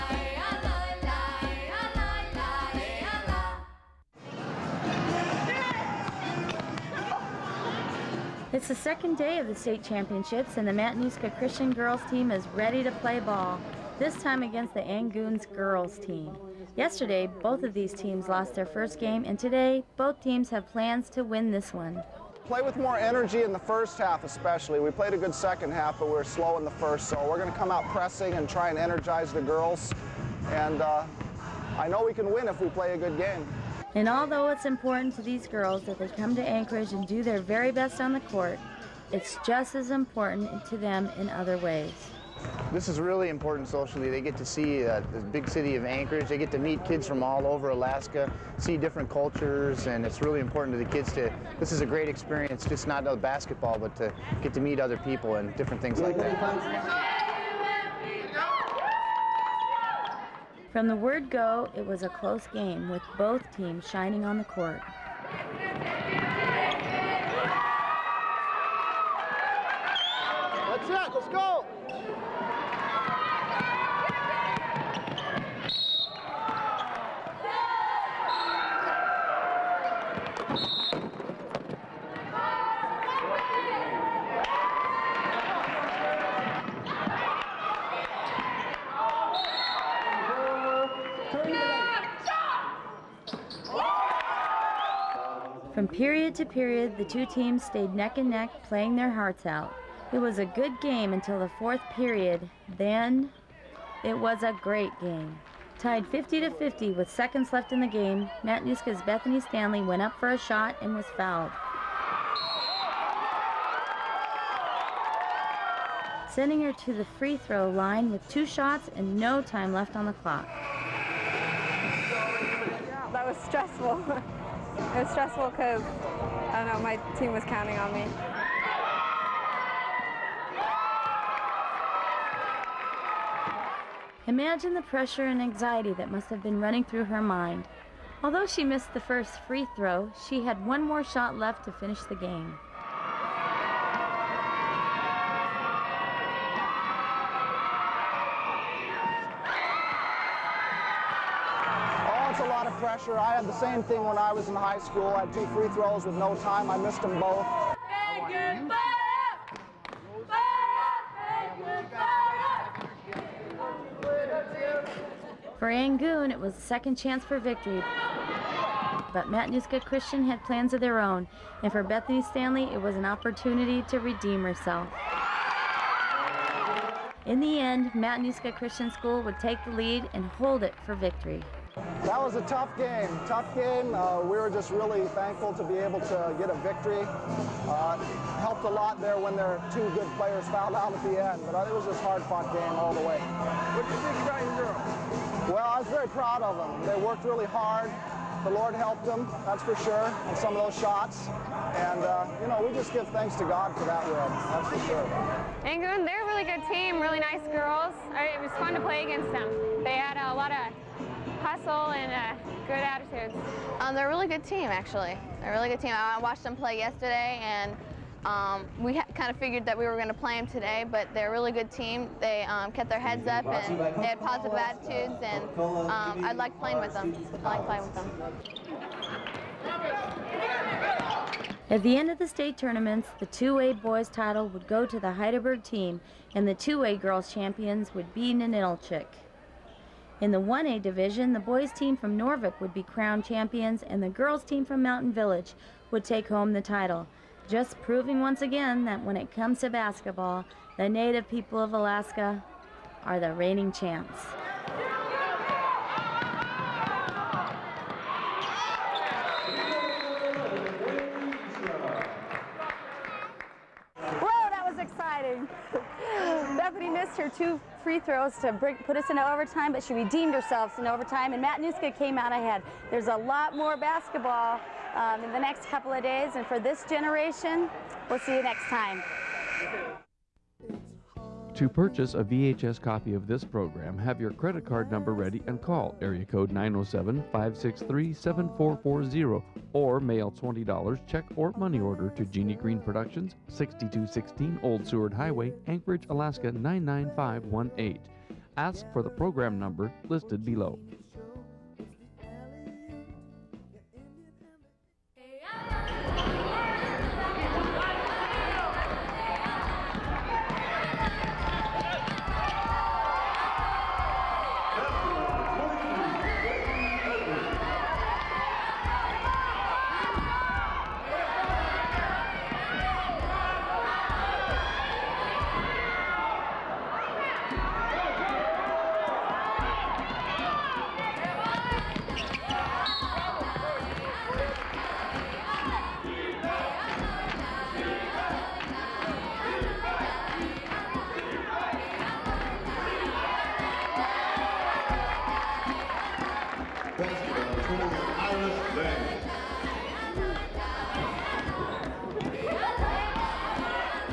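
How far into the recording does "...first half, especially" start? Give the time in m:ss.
0:23.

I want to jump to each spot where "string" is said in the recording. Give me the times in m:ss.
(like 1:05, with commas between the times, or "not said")
not said.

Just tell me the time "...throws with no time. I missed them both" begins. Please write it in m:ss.
2:35.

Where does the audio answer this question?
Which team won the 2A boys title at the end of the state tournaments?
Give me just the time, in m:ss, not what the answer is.
3:55.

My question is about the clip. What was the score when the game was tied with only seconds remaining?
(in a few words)
50 to 50.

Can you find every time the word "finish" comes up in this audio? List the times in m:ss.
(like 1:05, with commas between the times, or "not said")
2:21.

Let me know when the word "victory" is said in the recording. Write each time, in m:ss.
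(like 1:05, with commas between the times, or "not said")
2:47, 3:00, 3:06.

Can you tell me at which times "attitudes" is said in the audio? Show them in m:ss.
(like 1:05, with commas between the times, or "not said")
3:32, 3:44.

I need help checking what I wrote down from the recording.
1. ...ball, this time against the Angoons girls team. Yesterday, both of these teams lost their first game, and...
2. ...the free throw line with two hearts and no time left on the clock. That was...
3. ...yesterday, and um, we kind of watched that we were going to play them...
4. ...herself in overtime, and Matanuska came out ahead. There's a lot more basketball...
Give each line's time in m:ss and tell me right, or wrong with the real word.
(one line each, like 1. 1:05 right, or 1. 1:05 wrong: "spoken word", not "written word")
1. 0:13 right
2. 1:56 wrong: "shots", not "hearts"
3. 3:36 wrong: "figured", not "watched"
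4. 4:30 right.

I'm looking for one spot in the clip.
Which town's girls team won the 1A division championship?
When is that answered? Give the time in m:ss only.
4:04.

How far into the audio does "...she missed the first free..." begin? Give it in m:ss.
2:18.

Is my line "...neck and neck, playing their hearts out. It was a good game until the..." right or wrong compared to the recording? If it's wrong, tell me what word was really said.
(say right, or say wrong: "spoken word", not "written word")
right.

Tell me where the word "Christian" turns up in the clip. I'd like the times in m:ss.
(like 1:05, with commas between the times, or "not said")
0:11, 2:49, 2:58.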